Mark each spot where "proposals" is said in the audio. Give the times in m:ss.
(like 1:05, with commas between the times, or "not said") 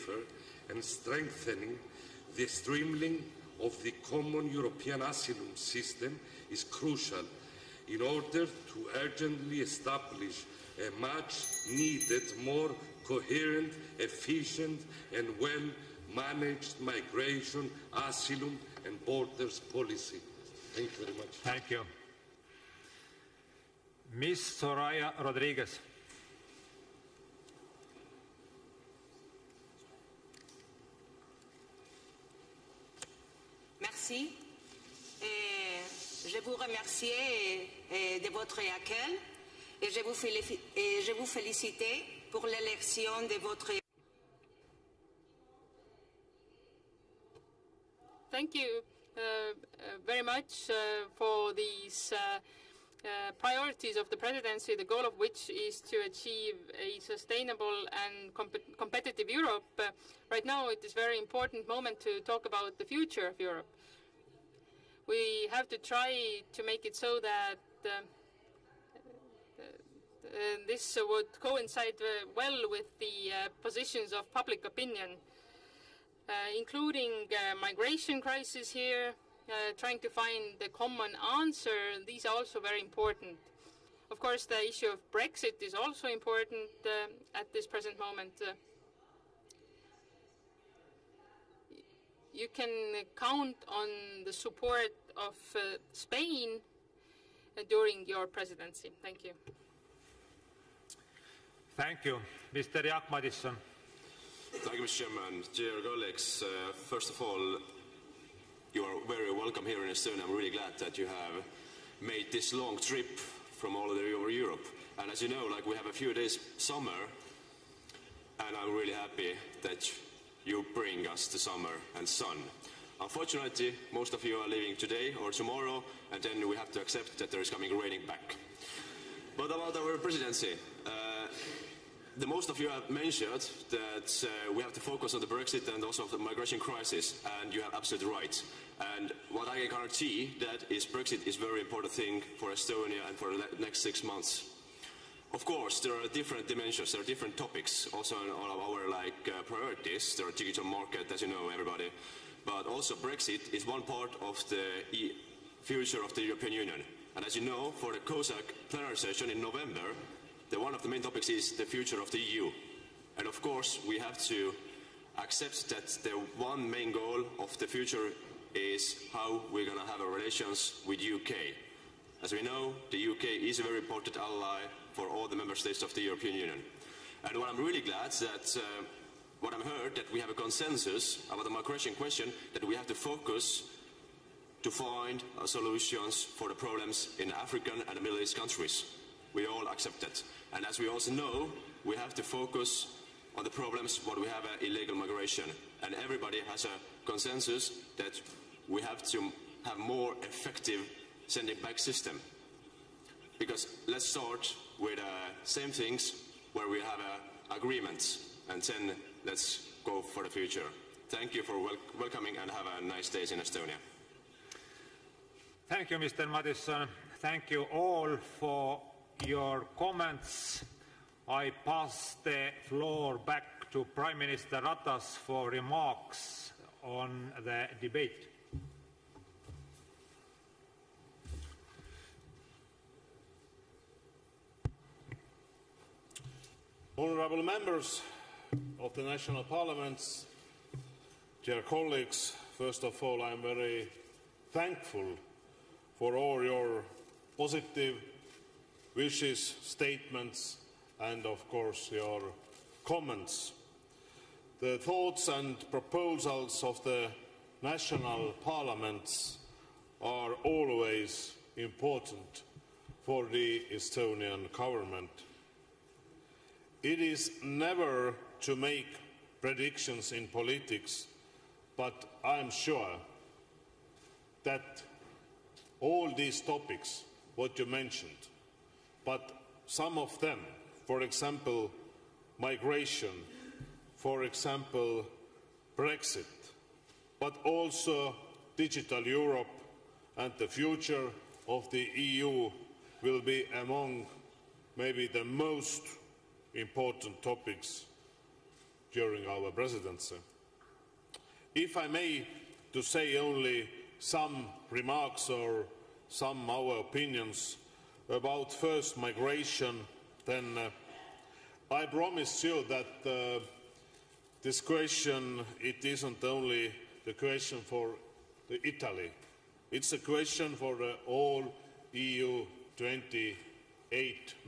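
4:15.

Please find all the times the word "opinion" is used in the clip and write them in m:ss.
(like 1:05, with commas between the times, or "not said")
1:14, 5:06.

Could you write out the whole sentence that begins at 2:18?
And what I can guarantee that is Brexit is a very important thing for Estonia and for the next six months.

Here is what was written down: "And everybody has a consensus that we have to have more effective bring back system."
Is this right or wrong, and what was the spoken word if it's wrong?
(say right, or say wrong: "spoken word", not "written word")
wrong: "sending", not "bring".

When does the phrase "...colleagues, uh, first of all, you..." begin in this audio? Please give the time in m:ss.
1:45.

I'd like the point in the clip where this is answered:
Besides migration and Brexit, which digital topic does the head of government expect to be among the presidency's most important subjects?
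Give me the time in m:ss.
4:48.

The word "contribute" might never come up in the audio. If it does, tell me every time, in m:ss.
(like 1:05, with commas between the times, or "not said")
not said.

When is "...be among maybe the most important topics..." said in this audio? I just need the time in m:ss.
4:53.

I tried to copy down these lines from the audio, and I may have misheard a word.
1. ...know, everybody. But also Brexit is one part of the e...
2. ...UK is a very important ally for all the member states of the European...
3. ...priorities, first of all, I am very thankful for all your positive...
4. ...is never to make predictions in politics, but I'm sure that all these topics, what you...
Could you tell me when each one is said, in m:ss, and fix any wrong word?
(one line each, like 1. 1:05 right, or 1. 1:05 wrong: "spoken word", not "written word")
1. 2:31 right
2. 2:53 right
3. 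4:01 wrong: "colleagues", not "priorities"
4. 4:26 right.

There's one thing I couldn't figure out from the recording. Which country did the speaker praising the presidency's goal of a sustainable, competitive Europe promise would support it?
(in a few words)
Spain.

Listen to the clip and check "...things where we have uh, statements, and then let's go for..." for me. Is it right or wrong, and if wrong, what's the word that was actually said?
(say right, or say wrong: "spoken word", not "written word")
wrong: "agreements", not "statements".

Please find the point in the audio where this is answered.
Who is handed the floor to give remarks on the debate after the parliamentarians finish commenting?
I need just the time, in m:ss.
3:43.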